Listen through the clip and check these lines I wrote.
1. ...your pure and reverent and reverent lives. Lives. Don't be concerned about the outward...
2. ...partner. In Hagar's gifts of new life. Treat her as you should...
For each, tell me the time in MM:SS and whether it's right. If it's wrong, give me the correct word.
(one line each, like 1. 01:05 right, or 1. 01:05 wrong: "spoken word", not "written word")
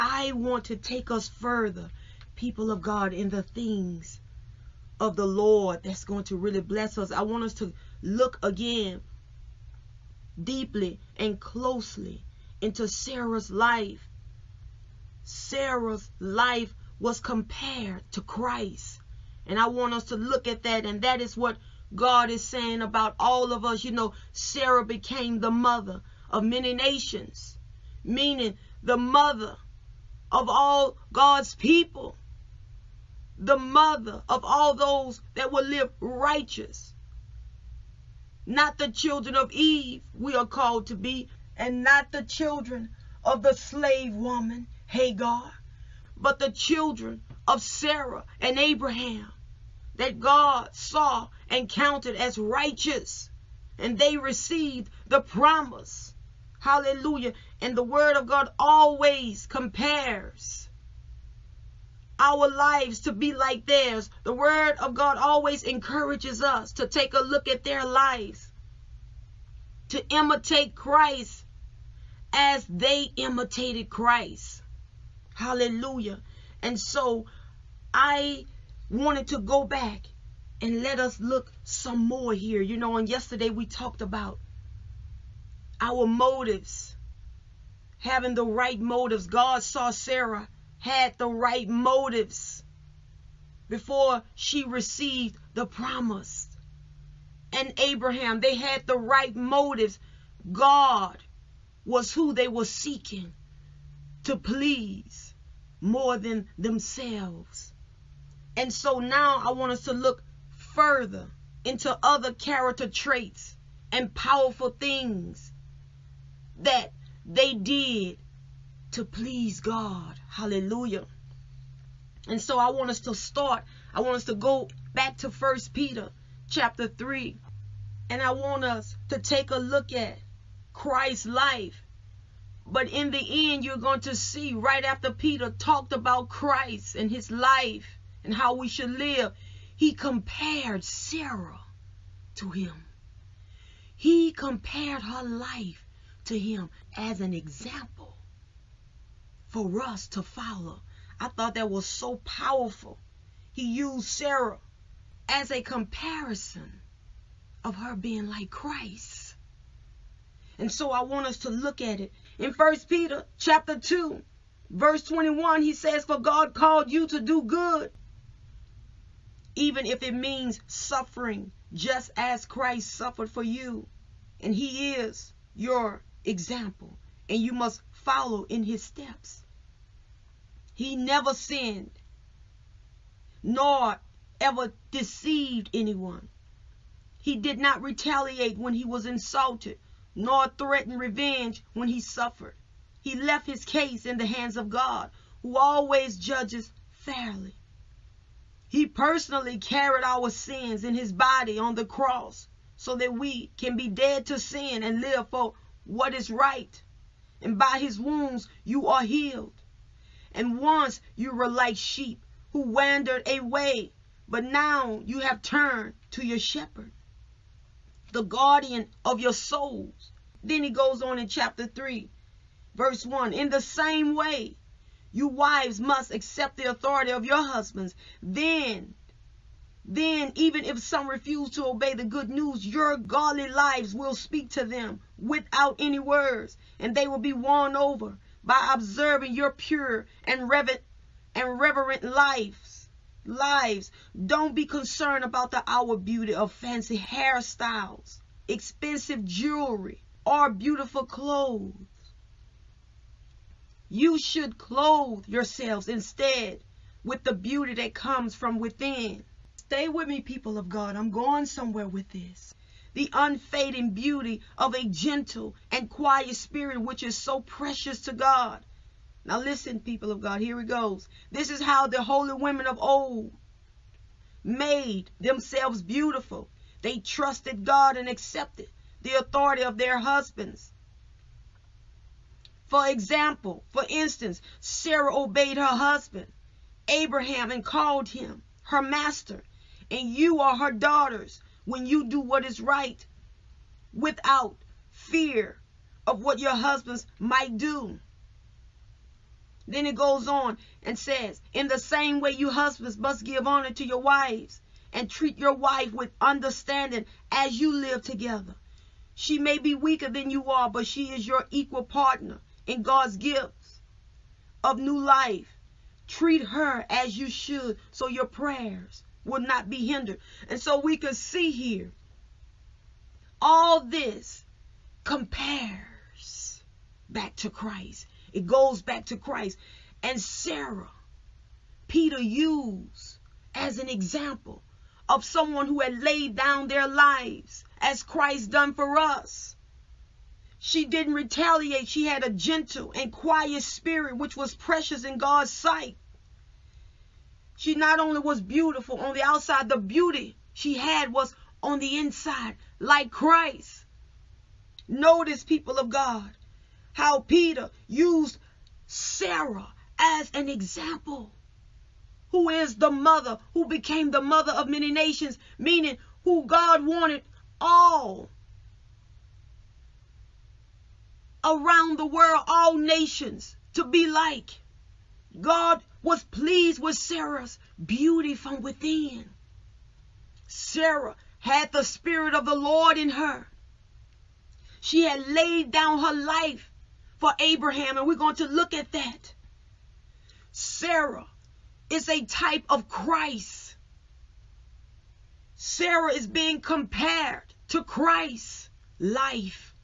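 1. 03:59 right
2. 05:11 wrong: "God", not "Hagar".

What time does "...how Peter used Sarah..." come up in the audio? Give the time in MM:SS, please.
05:56.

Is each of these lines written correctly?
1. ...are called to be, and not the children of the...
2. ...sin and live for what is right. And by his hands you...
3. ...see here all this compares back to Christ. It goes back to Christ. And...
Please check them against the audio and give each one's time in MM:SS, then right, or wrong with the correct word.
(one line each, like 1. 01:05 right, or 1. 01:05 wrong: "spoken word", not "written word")
1. 00:40 right
2. 03:24 wrong: "wounds", not "hands"
3. 05:21 right.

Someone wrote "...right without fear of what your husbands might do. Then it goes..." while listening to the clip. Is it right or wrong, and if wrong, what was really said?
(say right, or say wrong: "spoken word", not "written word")
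right.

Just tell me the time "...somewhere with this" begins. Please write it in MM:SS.
04:21.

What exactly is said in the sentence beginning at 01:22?
You know, and yesterday we talked about our motives, having the right motives.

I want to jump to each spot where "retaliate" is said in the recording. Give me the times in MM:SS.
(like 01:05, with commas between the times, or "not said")
03:07, 05:41.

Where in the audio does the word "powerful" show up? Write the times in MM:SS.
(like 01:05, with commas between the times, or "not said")
01:54, 02:32.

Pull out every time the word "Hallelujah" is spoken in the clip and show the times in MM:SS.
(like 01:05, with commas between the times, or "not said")
00:56, 01:15, 02:00.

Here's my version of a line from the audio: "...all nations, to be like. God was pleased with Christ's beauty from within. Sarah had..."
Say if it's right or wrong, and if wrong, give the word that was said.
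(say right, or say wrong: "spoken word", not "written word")
wrong: "Sarah", not "Christ".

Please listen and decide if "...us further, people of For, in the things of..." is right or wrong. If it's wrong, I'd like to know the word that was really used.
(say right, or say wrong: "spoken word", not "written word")
wrong: "God", not "For".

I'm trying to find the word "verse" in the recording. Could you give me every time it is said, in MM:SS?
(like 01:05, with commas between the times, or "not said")
02:44, 03:42.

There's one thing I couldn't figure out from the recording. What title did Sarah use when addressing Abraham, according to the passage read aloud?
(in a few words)
master.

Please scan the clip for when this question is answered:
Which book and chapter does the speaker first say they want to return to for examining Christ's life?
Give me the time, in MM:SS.
02:05.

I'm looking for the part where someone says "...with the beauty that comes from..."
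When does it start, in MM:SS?
04:17.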